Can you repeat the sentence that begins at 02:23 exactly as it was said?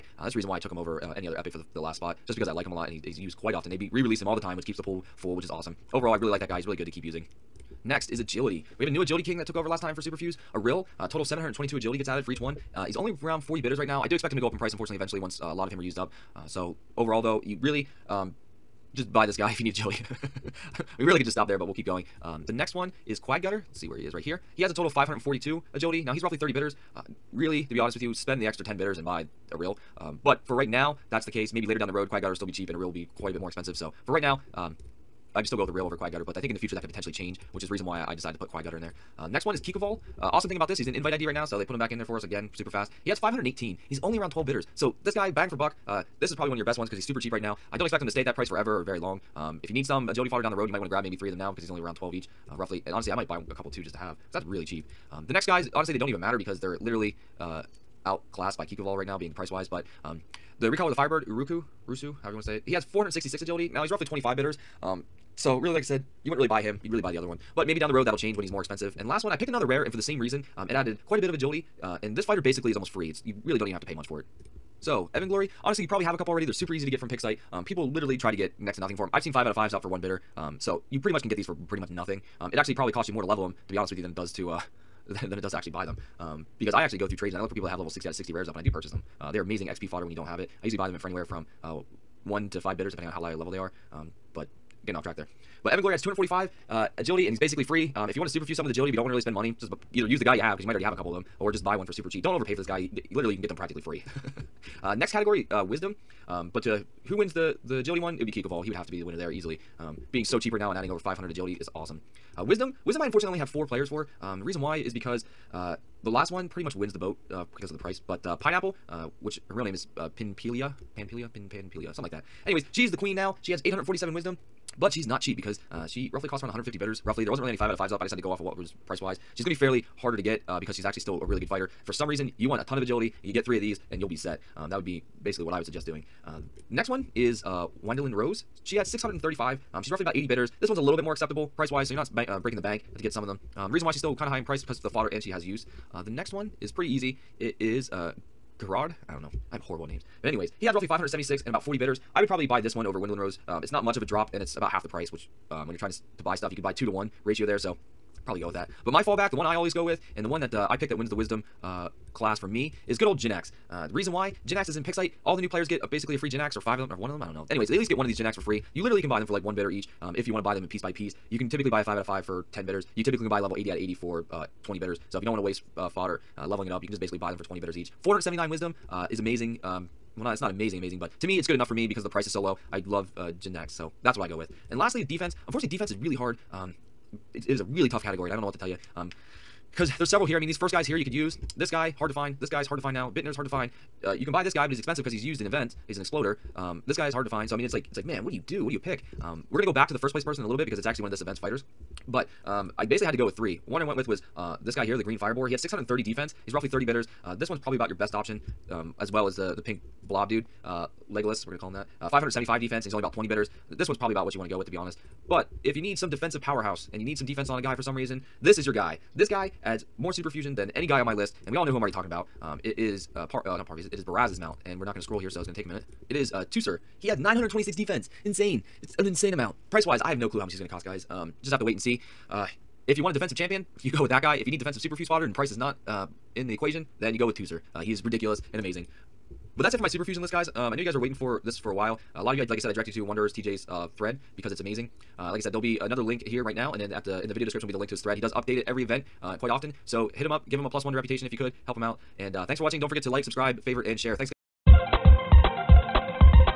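Um, reason why she's still kind of high in price because the fodder and she has use.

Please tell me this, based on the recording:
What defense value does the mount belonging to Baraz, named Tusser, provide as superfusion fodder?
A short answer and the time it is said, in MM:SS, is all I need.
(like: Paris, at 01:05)
926, at 03:47.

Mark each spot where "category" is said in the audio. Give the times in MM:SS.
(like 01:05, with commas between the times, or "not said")
01:45, 03:08.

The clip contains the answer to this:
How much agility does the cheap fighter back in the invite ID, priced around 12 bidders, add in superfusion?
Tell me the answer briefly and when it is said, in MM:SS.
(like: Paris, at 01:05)
518, at 00:43.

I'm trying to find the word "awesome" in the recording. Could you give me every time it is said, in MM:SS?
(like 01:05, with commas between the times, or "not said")
00:05, 00:40, 01:51.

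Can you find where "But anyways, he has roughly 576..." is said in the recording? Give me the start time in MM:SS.
02:30.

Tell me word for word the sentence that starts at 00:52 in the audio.
And honestly, I might buy a couple too just to have that's really cheap.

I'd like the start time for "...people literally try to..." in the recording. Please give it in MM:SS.
01:17.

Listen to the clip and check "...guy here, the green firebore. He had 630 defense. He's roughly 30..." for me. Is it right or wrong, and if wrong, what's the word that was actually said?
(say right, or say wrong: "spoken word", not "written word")
right.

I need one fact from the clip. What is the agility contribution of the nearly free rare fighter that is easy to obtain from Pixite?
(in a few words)
245.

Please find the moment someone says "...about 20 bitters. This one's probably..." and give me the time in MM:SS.
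03:32.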